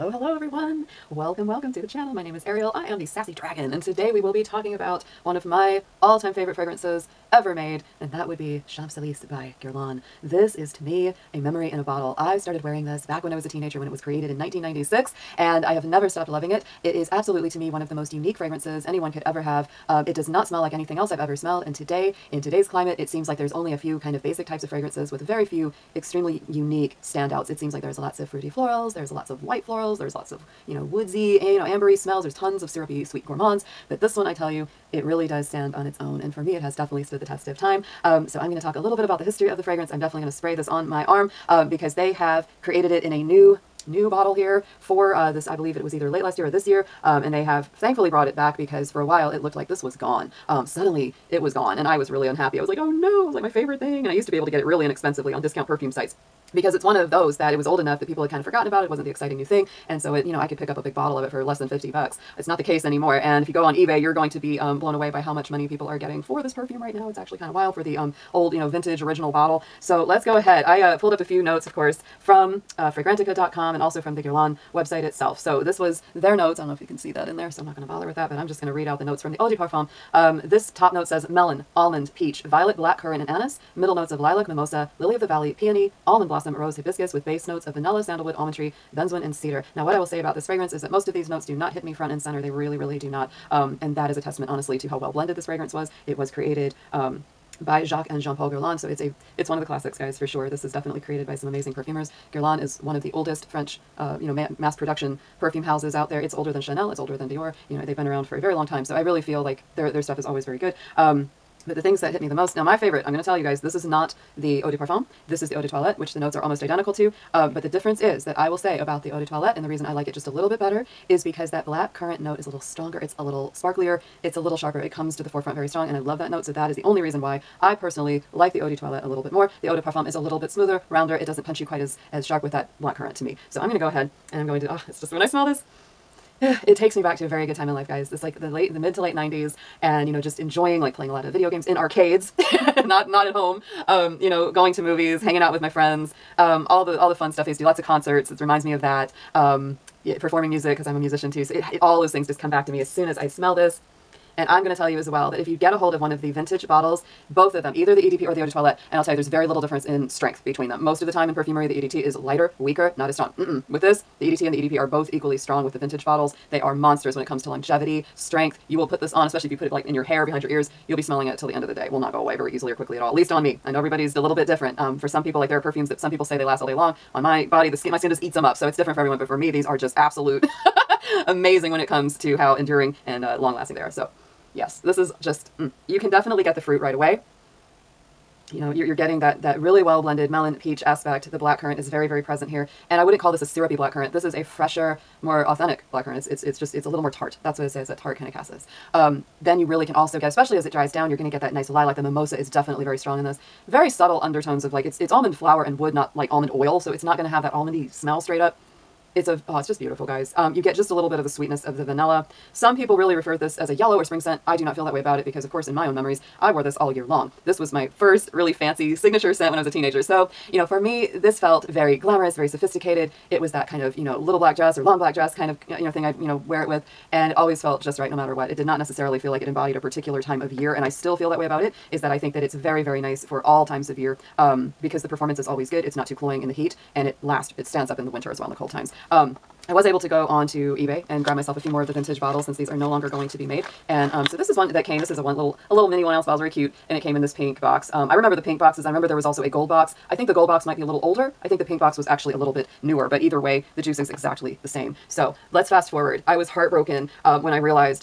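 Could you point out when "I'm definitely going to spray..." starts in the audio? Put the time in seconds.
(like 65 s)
39 s.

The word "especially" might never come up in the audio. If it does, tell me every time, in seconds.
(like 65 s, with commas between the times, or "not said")
169 s, 200 s.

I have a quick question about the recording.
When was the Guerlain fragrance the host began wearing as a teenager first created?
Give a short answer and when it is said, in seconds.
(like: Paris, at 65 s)
1996, at 14 s.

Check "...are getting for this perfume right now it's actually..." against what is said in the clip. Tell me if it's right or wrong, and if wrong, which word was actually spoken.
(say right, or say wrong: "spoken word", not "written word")
right.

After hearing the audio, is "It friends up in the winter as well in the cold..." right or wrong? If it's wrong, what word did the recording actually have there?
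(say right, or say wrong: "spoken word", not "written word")
wrong: "stands", not "friends".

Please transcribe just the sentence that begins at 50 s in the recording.
Um, suddenly it was gone and I was really unhappy.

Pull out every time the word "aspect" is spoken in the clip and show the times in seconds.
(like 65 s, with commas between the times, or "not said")
190 s.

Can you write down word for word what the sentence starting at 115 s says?
This is the Eau de Toilette, which the notes are almost identical to.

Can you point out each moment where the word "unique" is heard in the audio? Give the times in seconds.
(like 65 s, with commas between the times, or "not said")
18 s, 26 s.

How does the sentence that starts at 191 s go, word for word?
The black currant is very, very present here.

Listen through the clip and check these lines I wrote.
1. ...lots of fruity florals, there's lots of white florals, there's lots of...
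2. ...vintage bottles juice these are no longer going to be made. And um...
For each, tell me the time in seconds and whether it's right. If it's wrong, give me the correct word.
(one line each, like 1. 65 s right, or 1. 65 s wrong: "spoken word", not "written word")
1. 27 s right
2. 241 s wrong: "since", not "juice".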